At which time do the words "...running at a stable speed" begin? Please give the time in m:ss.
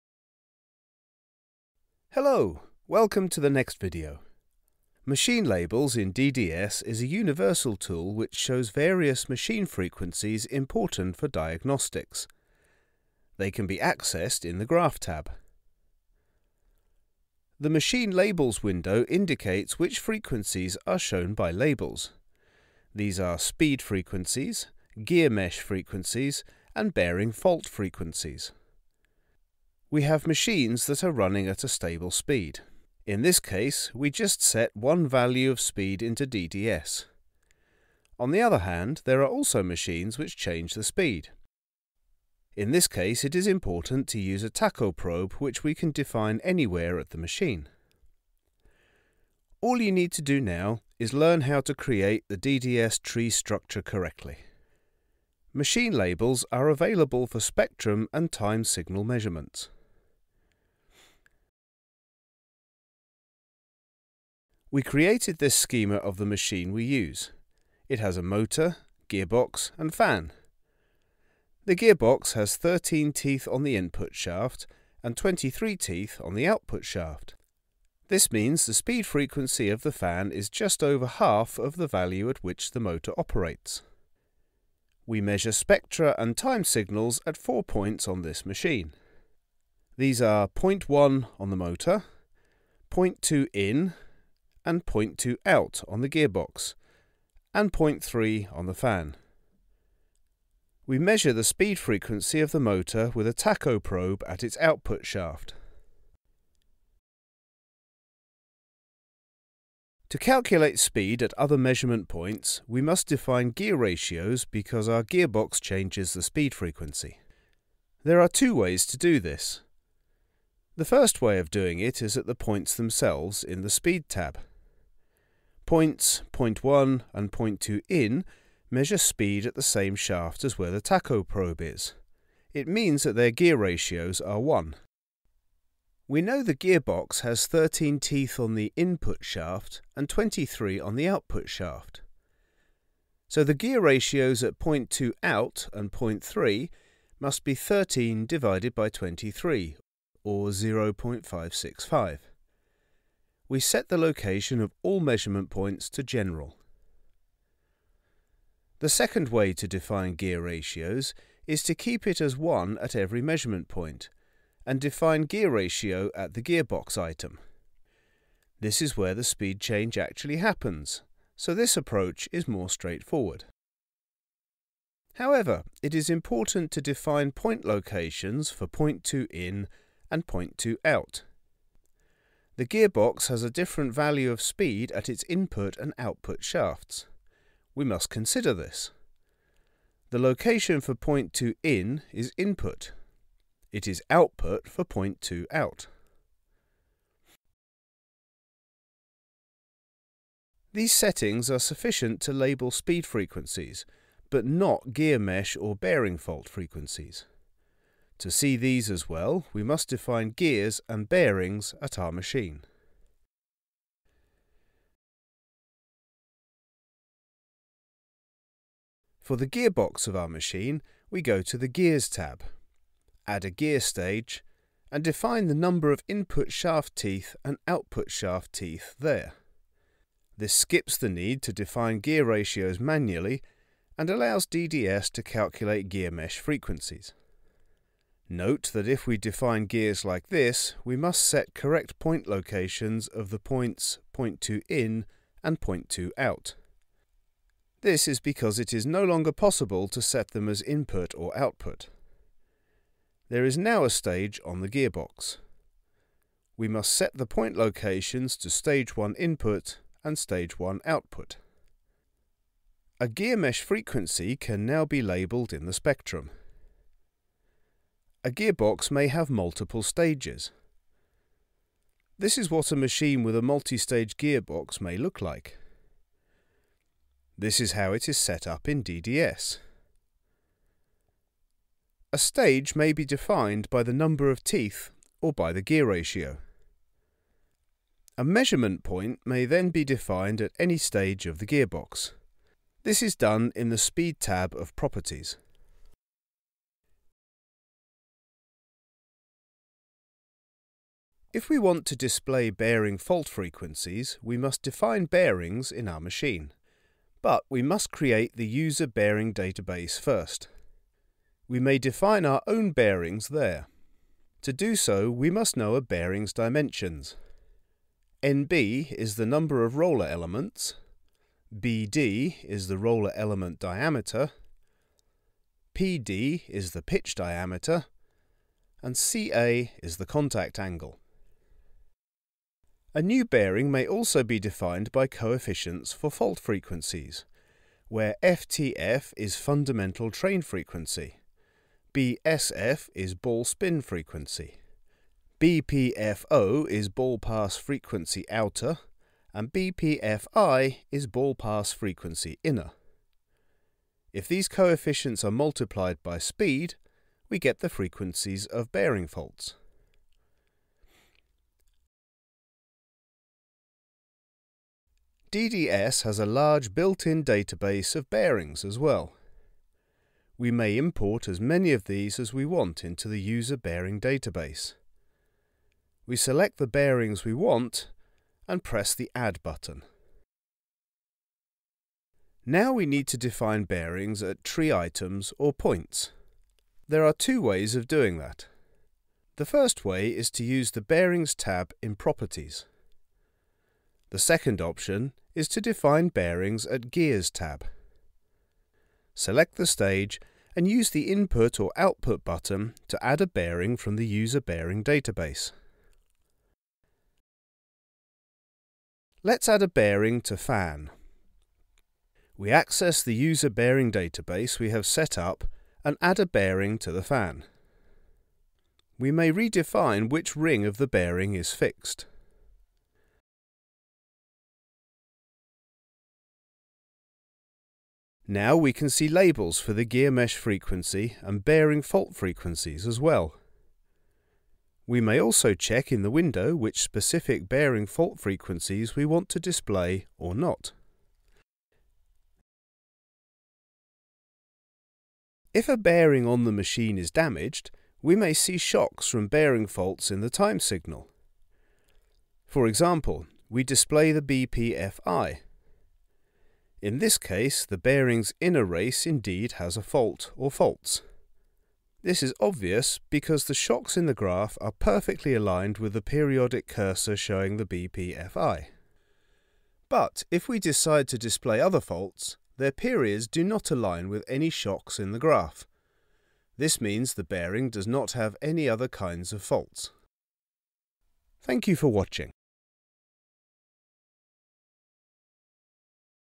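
0:31.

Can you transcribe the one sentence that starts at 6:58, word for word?
We may redefine which ring of the bearing is fixed.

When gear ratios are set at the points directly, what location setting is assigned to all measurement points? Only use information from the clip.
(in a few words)
general.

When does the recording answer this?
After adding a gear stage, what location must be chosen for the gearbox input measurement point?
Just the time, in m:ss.
4:18.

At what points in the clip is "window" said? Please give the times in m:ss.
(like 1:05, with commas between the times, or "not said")
0:18, 7:16.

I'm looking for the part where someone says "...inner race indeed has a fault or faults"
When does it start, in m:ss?
7:38.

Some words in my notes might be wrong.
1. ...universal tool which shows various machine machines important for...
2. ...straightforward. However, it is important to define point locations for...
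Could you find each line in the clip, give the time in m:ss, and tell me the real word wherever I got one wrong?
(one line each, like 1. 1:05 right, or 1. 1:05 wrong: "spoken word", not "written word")
1. 0:07 wrong: "frequencies", not "machines"
2. 2:52 right.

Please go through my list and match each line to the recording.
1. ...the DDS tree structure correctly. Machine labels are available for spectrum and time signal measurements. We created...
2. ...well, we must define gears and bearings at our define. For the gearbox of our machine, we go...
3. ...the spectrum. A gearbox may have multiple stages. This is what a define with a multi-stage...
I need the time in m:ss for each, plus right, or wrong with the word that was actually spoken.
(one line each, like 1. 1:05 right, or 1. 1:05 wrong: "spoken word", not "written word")
1. 0:52 right
2. 3:29 wrong: "machine", not "define"
3. 4:25 wrong: "machine", not "define".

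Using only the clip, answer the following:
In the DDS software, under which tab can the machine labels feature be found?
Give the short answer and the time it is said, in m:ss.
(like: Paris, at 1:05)
Graph tab, at 0:14.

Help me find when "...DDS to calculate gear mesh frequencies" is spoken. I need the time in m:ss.
3:54.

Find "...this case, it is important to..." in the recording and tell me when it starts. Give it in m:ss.
0:42.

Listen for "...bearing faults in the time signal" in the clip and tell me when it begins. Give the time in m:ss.
7:29.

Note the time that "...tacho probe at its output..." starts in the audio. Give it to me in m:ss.
1:43.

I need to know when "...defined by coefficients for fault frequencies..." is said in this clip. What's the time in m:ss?
5:34.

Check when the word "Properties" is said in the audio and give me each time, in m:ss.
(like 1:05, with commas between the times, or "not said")
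4:54, 6:31.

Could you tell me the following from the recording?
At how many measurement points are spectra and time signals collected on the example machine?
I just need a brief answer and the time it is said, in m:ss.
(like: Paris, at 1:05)
4, at 1:27.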